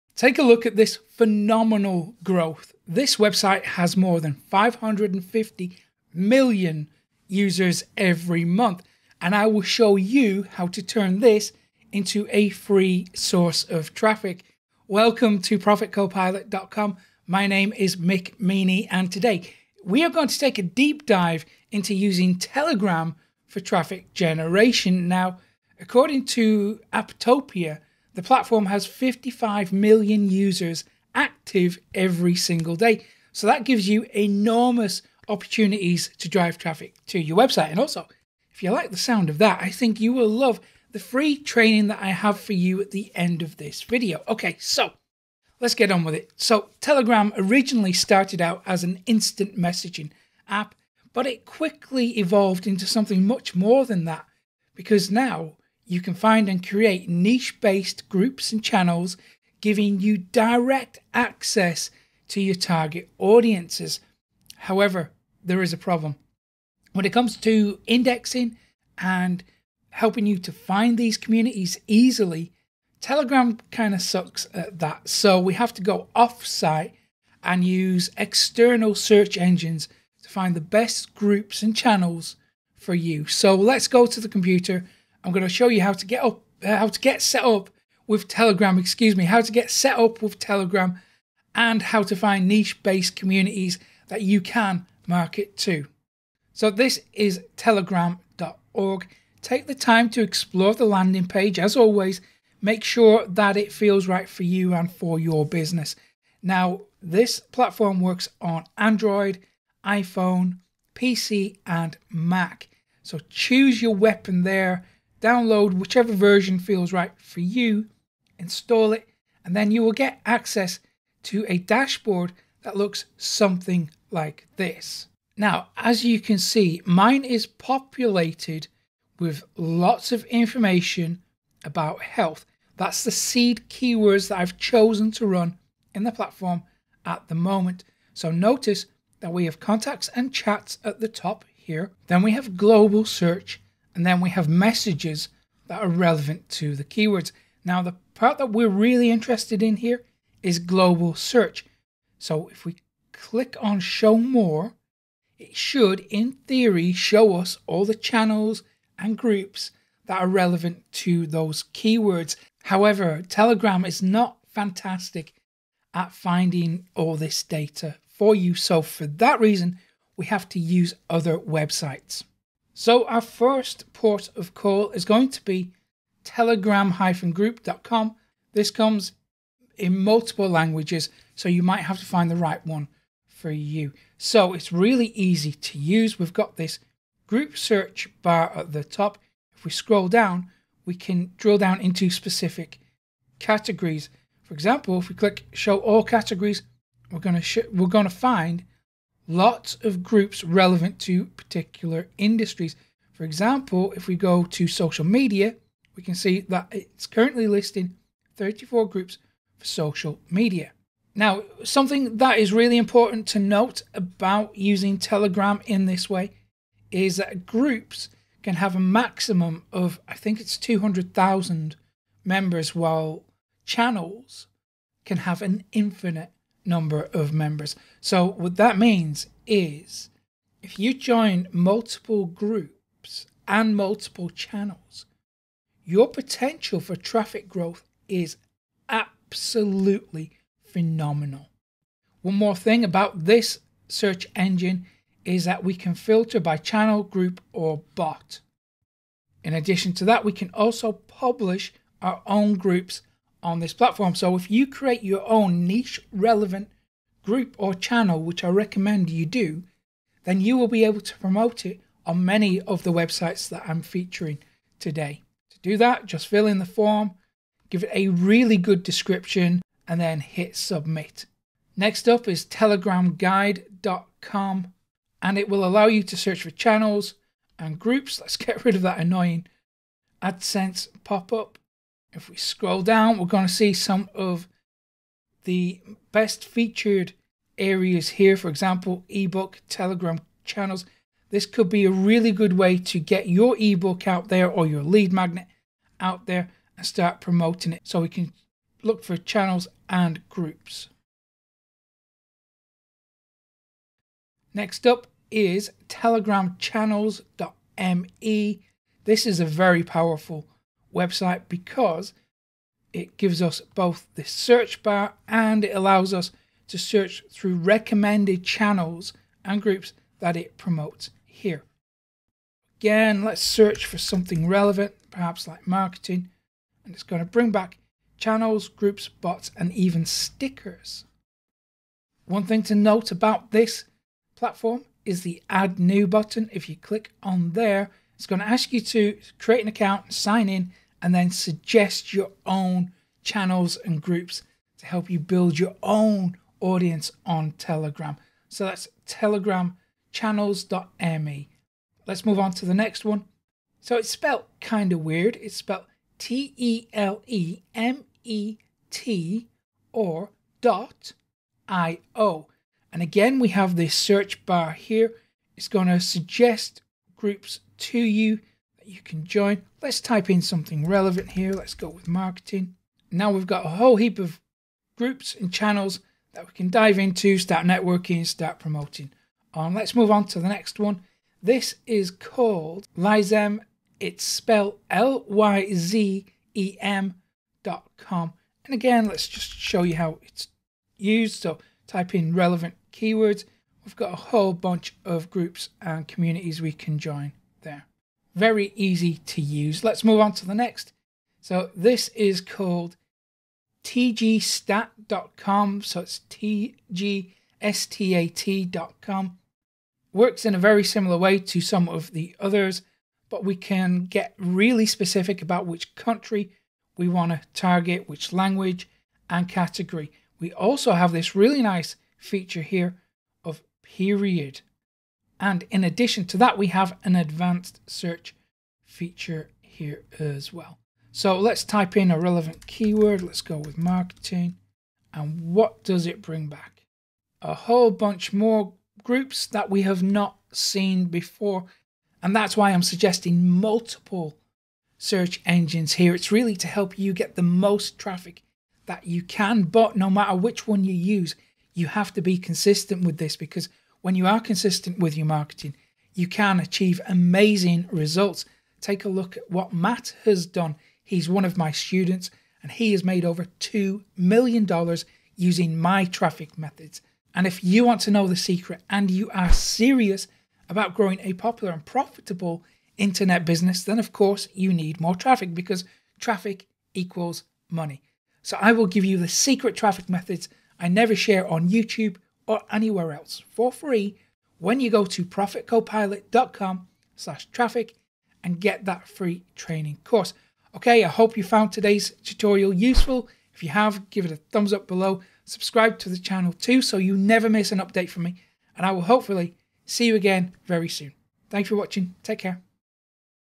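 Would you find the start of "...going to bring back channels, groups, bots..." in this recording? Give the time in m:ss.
5:27.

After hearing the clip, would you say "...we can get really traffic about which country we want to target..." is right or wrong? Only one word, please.
wrong.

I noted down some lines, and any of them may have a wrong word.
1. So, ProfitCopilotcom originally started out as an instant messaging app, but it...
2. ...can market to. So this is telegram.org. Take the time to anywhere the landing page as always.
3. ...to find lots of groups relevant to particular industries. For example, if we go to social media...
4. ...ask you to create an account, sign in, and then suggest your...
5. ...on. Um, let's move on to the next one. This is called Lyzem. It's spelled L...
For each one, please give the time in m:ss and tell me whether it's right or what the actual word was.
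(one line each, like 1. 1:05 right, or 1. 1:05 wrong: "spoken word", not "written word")
1. 0:46 wrong: "Telegram", not "ProfitCopilotcom"
2. 1:34 wrong: "explore", not "anywhere"
3. 3:18 right
4. 5:38 right
5. 6:19 right.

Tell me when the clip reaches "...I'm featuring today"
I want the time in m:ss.
4:23.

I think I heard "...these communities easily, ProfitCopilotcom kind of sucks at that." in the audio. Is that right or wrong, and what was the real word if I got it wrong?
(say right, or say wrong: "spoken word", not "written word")
wrong: "Telegram", not "ProfitCopilotcom".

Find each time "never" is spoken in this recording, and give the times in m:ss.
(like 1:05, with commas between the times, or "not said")
8:00, 8:17.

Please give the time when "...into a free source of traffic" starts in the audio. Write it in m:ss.
0:11.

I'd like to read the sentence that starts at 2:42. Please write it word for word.
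However, Telegram is not fantastic at finding all this data for you.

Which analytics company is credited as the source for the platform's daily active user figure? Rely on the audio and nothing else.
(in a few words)
Apptopia.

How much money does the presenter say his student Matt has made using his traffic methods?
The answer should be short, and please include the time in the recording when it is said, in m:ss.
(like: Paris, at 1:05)
over $2 million, at 7:43.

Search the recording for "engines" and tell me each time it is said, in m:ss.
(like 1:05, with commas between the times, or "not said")
1:19, 4:04, 7:25.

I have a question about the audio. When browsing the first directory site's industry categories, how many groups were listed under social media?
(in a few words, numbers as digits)
34.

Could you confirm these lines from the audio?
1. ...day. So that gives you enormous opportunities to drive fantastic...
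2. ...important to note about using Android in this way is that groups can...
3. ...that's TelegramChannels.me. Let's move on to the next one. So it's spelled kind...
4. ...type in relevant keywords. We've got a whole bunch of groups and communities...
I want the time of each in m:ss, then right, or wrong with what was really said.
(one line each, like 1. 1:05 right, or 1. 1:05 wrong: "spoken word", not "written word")
1. 0:32 wrong: "traffic", not "fantastic"
2. 3:32 wrong: "Telegram", not "Android"
3. 5:48 right
4. 6:31 right.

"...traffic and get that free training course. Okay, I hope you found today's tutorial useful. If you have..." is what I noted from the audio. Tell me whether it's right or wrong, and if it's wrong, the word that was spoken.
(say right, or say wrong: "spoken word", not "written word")
right.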